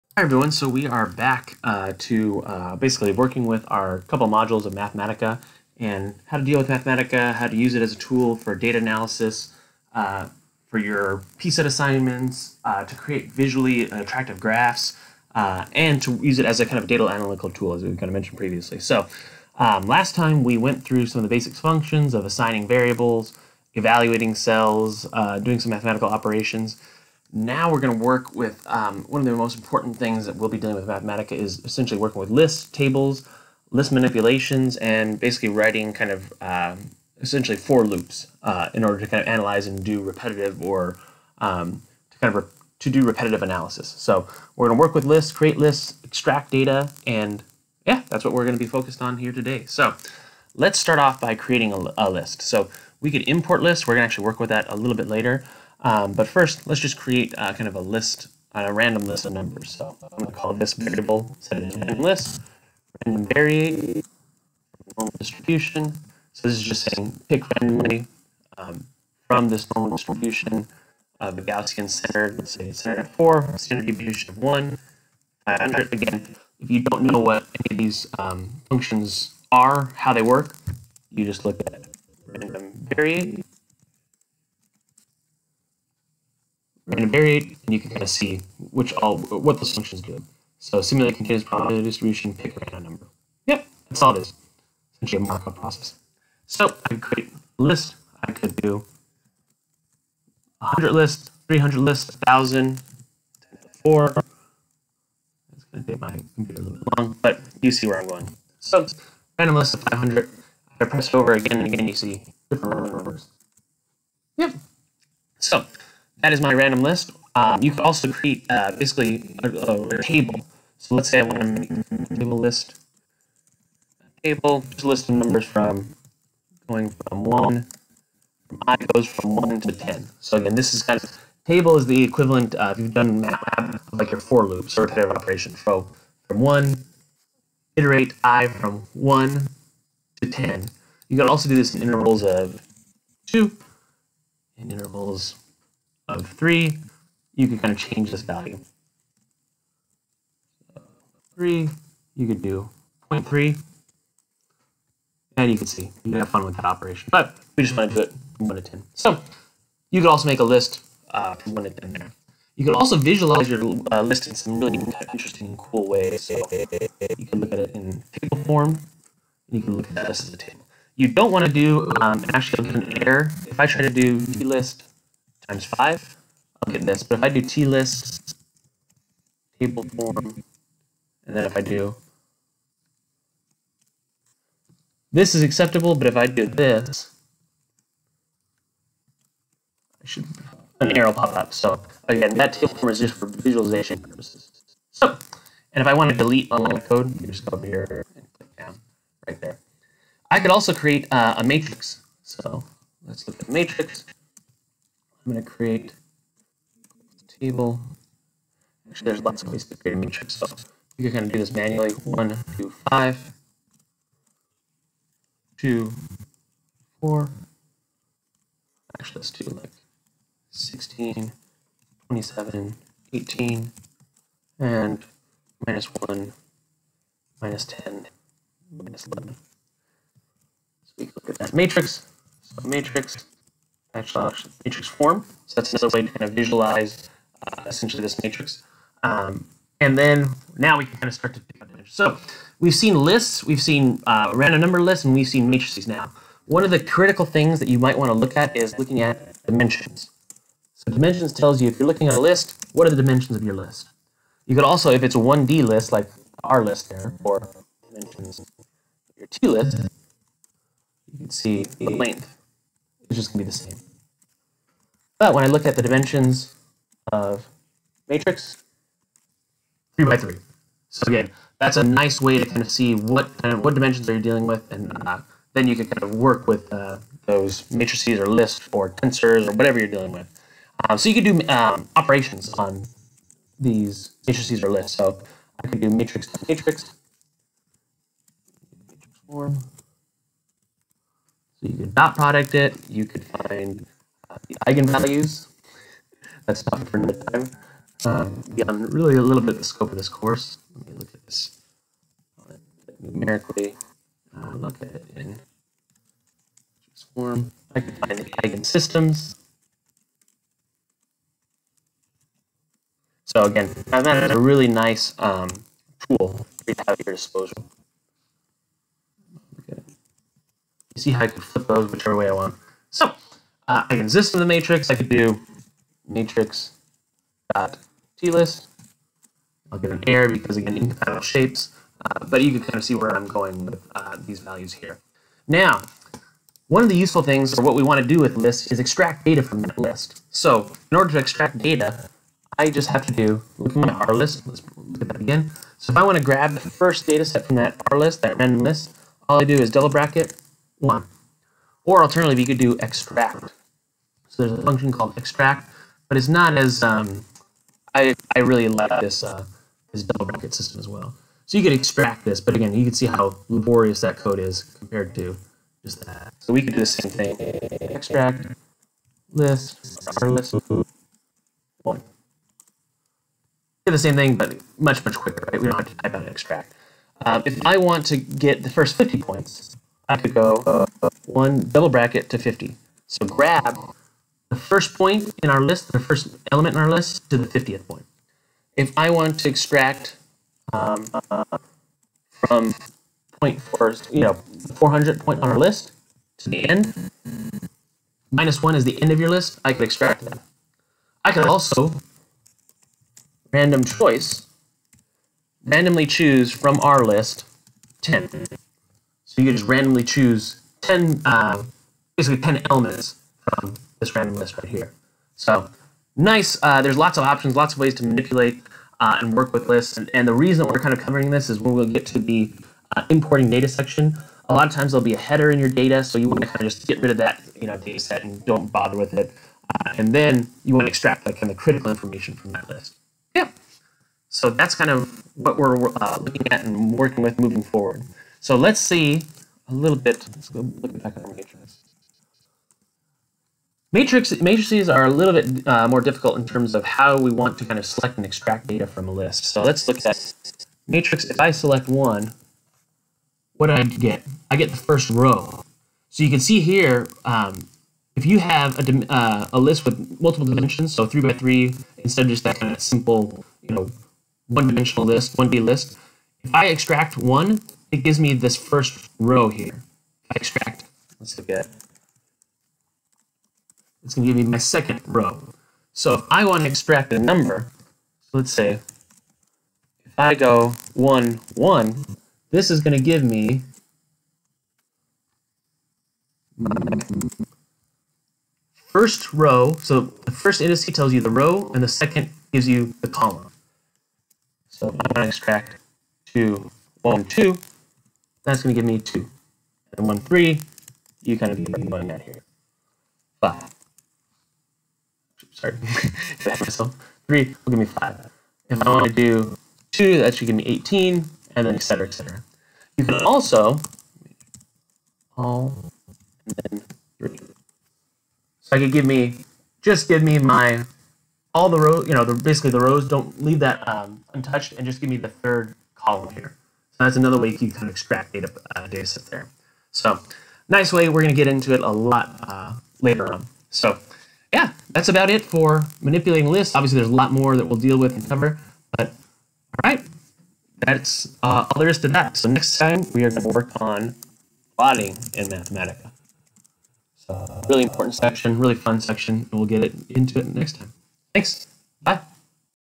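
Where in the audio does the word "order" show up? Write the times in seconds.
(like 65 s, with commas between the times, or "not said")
38 s, 340 s.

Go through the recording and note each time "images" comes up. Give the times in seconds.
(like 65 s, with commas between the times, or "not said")
241 s.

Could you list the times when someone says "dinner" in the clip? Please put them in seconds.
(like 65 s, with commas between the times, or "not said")
not said.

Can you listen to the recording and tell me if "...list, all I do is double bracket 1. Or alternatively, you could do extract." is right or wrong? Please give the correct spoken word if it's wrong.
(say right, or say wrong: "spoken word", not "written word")
right.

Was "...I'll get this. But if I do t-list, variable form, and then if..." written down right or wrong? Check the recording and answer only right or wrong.
wrong.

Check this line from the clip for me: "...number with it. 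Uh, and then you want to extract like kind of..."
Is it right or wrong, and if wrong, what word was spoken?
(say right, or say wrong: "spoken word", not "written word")
wrong: "bother", not "number".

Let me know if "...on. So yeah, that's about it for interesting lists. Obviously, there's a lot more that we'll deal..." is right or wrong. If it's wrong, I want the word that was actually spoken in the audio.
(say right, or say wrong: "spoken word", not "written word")
wrong: "manipulating", not "interesting".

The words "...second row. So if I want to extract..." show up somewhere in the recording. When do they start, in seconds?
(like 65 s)
474 s.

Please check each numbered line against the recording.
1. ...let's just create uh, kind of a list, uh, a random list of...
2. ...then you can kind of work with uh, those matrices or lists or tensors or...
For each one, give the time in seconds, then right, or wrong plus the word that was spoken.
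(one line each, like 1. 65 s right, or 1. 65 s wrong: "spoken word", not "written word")
1. 56 s right
2. 275 s right.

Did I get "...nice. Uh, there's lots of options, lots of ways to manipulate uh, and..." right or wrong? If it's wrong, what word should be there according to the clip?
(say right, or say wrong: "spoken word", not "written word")
right.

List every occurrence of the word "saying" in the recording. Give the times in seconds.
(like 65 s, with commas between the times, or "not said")
66 s.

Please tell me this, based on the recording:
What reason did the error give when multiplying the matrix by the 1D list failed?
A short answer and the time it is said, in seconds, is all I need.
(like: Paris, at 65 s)
incompatible shapes, at 330 s.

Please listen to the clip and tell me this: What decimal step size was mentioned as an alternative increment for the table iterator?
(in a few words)
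0.3.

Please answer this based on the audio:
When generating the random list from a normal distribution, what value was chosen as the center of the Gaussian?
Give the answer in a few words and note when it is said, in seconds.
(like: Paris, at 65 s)
4, at 72 s.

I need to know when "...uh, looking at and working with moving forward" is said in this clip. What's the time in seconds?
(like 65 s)
436 s.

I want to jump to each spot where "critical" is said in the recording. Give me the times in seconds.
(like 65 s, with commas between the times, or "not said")
246 s, 431 s.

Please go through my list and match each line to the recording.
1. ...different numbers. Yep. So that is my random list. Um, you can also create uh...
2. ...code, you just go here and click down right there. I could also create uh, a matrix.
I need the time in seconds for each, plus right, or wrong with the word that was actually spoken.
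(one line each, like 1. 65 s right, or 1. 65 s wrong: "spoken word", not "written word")
1. 112 s right
2. 196 s right.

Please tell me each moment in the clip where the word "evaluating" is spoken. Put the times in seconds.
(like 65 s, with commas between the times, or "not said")
23 s.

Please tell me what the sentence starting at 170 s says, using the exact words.
You don't want to do, um, actually, an error.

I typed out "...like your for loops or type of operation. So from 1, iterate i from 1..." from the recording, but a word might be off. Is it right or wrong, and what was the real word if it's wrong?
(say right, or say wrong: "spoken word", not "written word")
right.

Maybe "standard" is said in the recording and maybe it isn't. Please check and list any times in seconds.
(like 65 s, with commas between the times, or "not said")
73 s.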